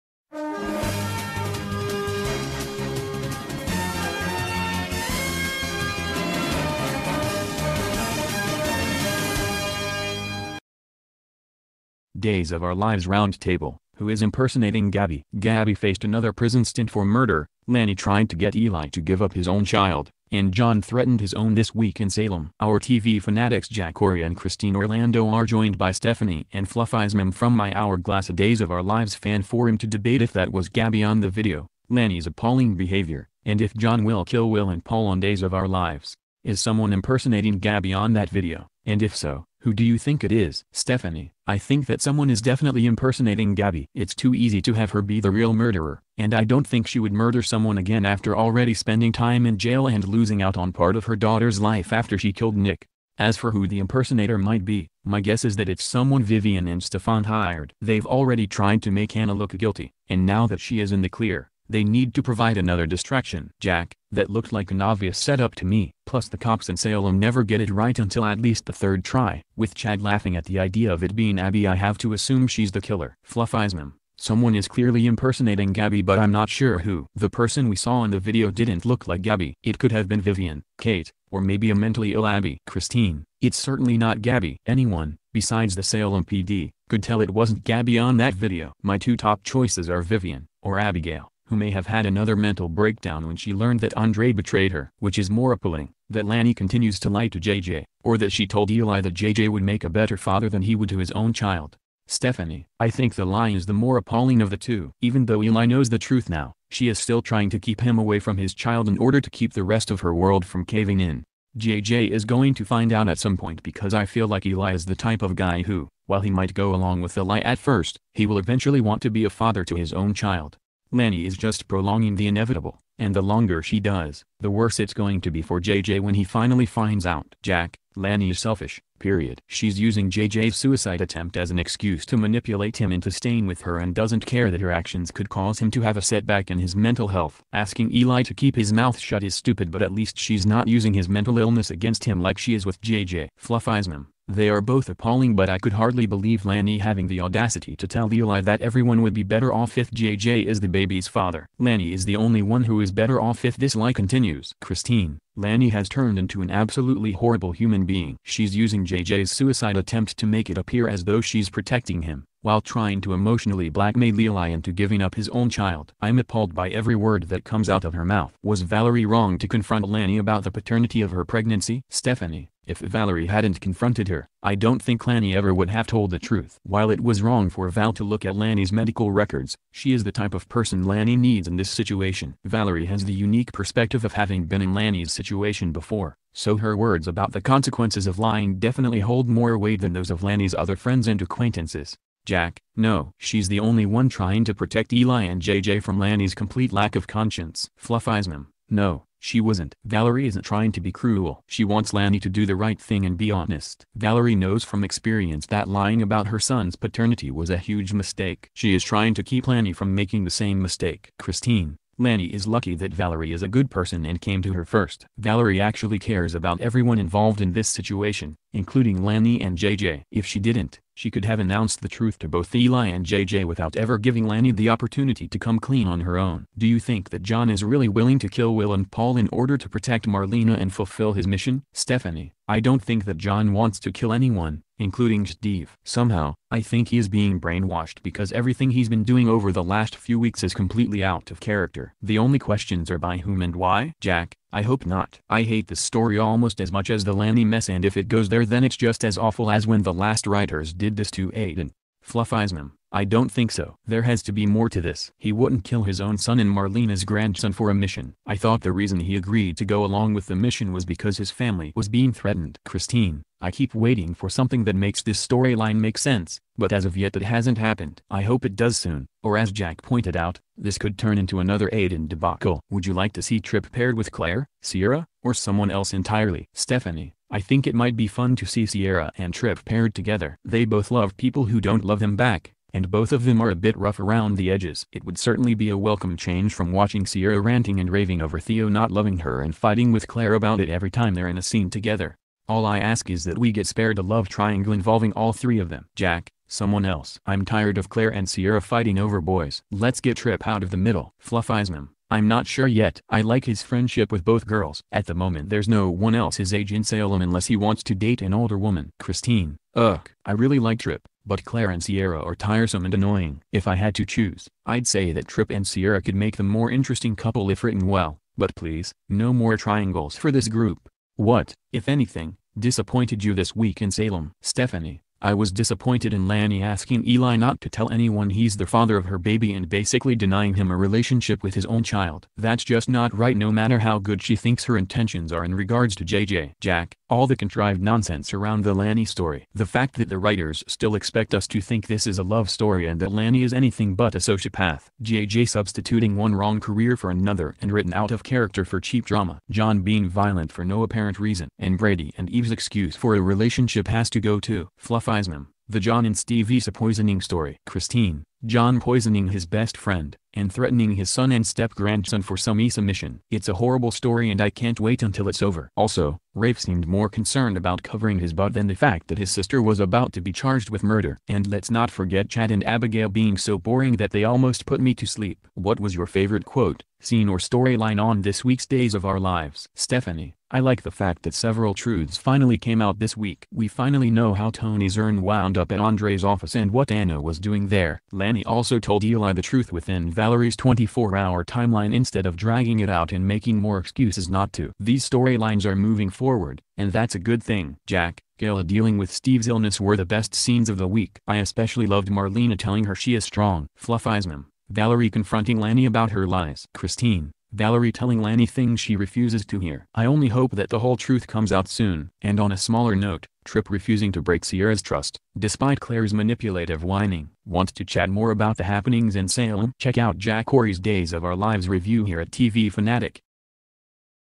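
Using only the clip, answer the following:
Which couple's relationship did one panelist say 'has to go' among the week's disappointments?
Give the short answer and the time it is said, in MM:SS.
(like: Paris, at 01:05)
Brady and Eve, at 05:51.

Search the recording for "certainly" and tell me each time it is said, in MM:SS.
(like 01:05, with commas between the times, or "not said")
01:23, 04:45.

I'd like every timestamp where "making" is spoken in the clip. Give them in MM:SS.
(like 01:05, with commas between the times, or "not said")
03:29, 06:33.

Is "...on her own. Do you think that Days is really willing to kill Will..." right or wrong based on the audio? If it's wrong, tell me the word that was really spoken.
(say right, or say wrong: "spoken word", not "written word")
wrong: "John", not "Days".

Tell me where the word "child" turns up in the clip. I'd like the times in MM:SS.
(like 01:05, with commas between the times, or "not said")
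00:19, 01:41, 01:48, 02:00, 02:45, 05:31.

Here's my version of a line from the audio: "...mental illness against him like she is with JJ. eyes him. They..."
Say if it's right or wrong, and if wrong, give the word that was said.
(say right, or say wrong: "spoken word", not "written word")
right.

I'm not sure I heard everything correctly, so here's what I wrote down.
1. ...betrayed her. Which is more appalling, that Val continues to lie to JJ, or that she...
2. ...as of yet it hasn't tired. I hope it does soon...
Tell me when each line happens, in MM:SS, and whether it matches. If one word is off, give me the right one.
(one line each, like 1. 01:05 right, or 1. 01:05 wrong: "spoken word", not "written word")
1. 01:34 wrong: "Lani", not "Val"
2. 04:26 wrong: "happened", not "tired".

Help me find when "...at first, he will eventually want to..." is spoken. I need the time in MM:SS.
01:57.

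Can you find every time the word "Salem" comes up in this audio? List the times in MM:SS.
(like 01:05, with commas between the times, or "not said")
00:22, 01:06, 01:25, 05:06, 05:23, 06:59.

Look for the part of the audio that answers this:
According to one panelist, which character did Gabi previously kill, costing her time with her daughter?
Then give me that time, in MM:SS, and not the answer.
00:52.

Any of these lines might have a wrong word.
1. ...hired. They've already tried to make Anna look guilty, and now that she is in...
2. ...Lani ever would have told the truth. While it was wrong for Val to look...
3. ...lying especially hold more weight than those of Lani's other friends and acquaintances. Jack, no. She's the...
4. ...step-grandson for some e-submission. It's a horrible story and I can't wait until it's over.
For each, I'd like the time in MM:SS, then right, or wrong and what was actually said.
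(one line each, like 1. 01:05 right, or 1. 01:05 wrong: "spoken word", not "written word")
1. 00:57 right
2. 02:55 right
3. 03:08 wrong: "definitely", not "especially"
4. 06:01 right.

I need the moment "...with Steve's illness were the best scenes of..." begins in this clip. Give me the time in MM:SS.
06:38.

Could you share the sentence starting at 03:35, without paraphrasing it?
Valerie actually cares about everyone involved in this situation, including Lani and JJ.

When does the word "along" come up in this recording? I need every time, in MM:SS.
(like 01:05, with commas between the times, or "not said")
01:56, 04:19.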